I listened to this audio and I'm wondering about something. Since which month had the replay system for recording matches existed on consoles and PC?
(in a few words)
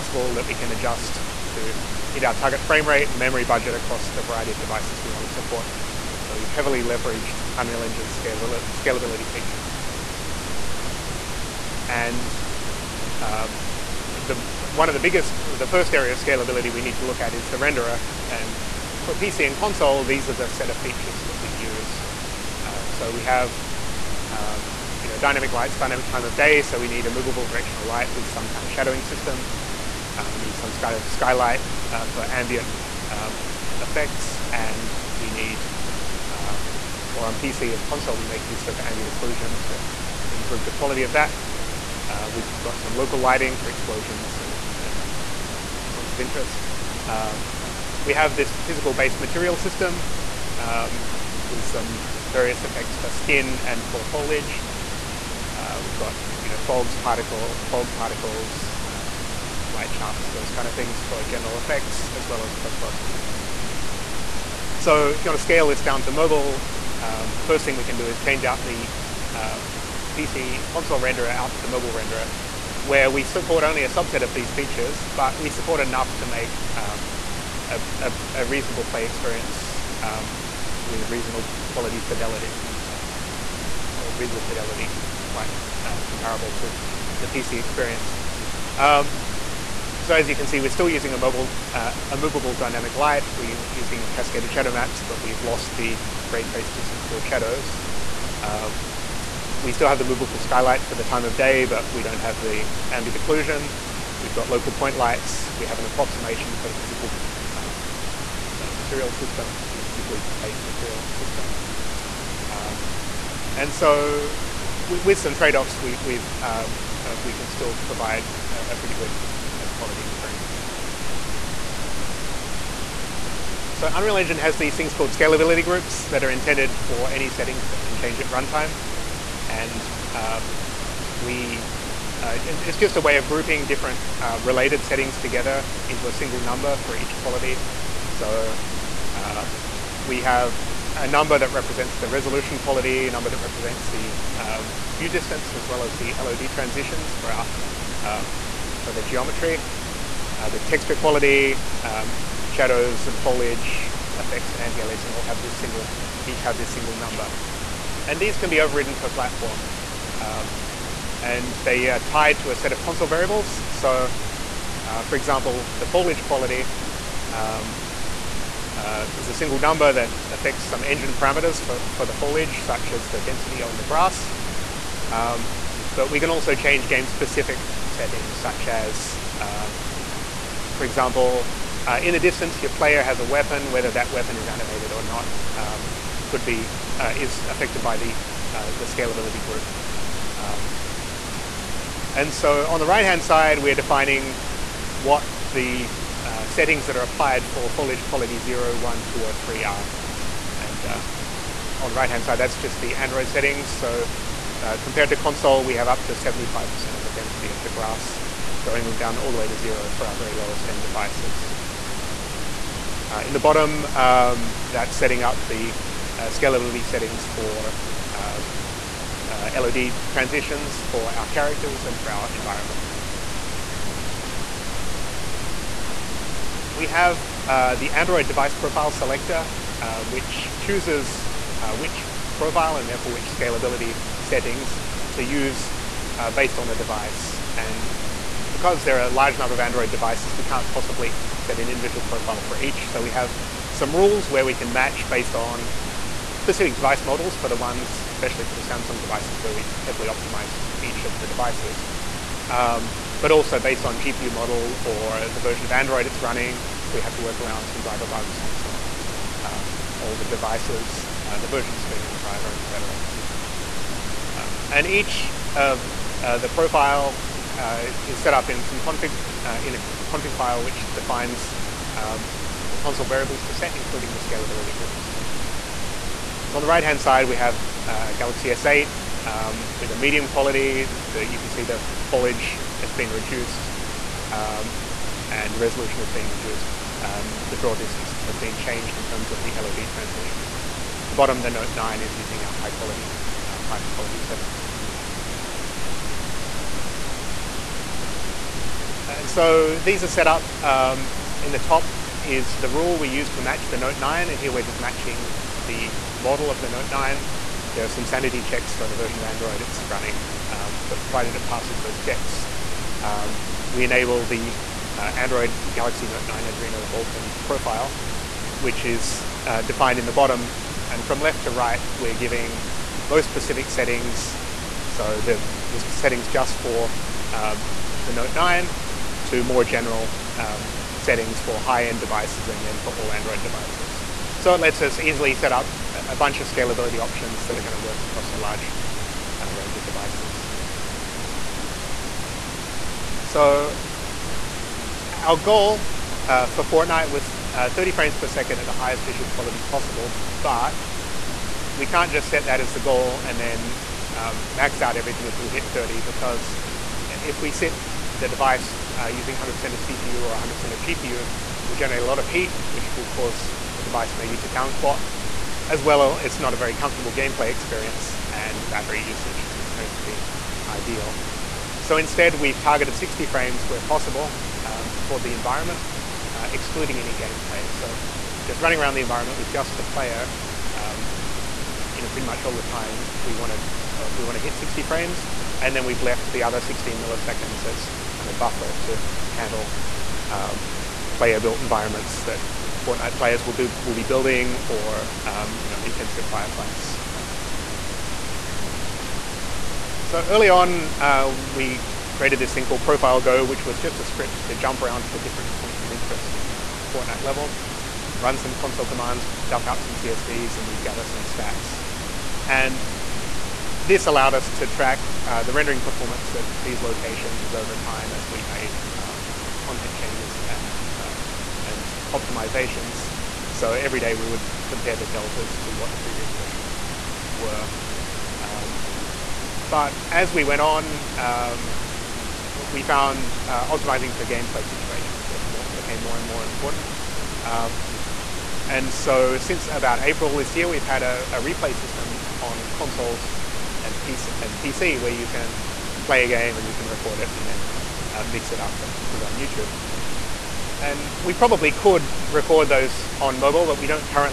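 April.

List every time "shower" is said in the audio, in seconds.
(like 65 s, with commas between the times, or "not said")
not said.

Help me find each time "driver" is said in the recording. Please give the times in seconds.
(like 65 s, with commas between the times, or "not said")
257 s, 262 s.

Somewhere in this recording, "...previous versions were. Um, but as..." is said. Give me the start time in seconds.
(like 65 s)
425 s.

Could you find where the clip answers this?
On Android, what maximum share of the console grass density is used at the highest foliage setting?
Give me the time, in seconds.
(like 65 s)
206 s.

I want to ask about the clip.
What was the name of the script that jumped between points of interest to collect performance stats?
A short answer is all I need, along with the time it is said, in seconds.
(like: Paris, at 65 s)
Profile Go, at 402 s.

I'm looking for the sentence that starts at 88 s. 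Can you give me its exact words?
Um, so as you can see, we're still using a, mobile, uh, a movable dynamic light.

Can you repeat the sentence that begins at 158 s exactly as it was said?
And these can be overridden per platform.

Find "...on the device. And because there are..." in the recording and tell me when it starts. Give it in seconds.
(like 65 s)
236 s.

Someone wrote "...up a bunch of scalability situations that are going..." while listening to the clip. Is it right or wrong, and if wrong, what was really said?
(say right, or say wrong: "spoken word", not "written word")
wrong: "options", not "situations".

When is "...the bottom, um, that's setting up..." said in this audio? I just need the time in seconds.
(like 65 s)
213 s.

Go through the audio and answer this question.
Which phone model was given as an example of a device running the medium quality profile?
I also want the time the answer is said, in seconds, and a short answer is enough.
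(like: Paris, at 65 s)
Galaxy S8, at 278 s.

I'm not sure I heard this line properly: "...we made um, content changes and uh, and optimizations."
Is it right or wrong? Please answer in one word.
right.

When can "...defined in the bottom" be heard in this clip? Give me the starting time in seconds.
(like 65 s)
319 s.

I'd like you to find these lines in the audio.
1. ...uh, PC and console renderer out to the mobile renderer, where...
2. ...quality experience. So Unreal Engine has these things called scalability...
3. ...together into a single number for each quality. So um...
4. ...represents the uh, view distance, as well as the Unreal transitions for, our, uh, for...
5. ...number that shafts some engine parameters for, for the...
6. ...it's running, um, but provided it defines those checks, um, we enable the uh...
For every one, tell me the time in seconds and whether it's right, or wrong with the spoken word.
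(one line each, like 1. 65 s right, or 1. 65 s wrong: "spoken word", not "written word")
1. 69 s right
2. 119 s right
3. 135 s right
4. 143 s wrong: "LOD", not "Unreal"
5. 169 s wrong: "affects", not "shafts"
6. 309 s wrong: "passes", not "defines".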